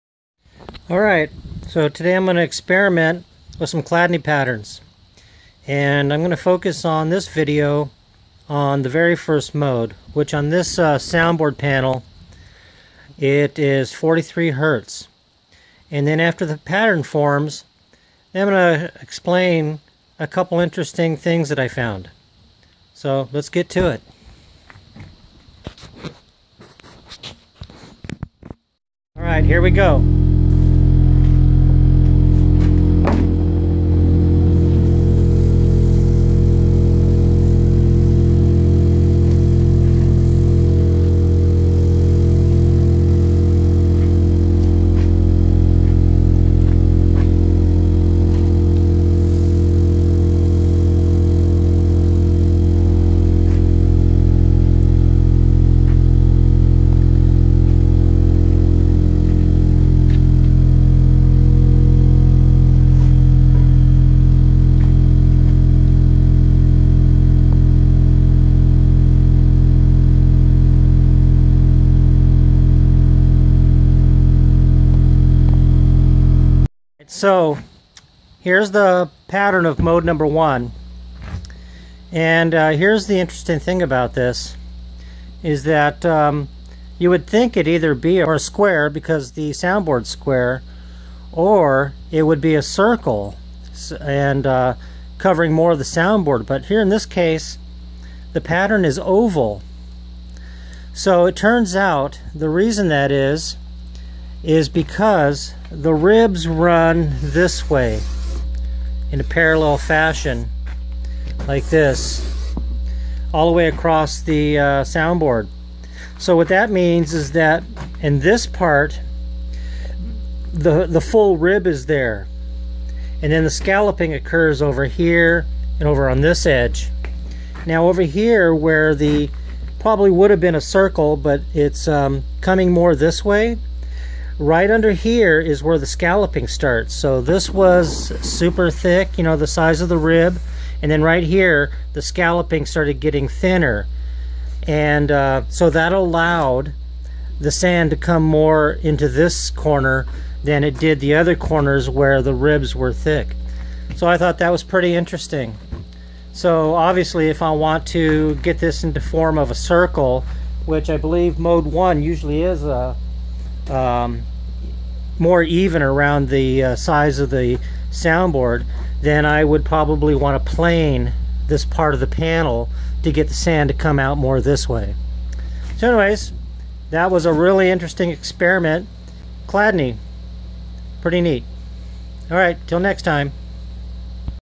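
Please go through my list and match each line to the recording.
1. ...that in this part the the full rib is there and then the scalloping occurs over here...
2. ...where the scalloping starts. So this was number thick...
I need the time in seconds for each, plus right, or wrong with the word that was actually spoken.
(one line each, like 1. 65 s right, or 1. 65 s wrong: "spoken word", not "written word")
1. 117 s right
2. 135 s wrong: "super", not "number".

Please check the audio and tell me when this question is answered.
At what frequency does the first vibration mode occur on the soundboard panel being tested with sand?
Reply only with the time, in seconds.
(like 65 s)
13 s.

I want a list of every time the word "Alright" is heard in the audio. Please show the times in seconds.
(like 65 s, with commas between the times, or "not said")
0 s, 29 s.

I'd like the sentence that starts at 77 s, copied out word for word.
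So here's the pattern of mode number one.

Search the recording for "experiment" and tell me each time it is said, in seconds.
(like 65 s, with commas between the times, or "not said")
2 s, 178 s.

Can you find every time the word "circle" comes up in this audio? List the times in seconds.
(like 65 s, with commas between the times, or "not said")
92 s, 130 s, 159 s.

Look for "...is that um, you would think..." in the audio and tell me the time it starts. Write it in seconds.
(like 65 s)
85 s.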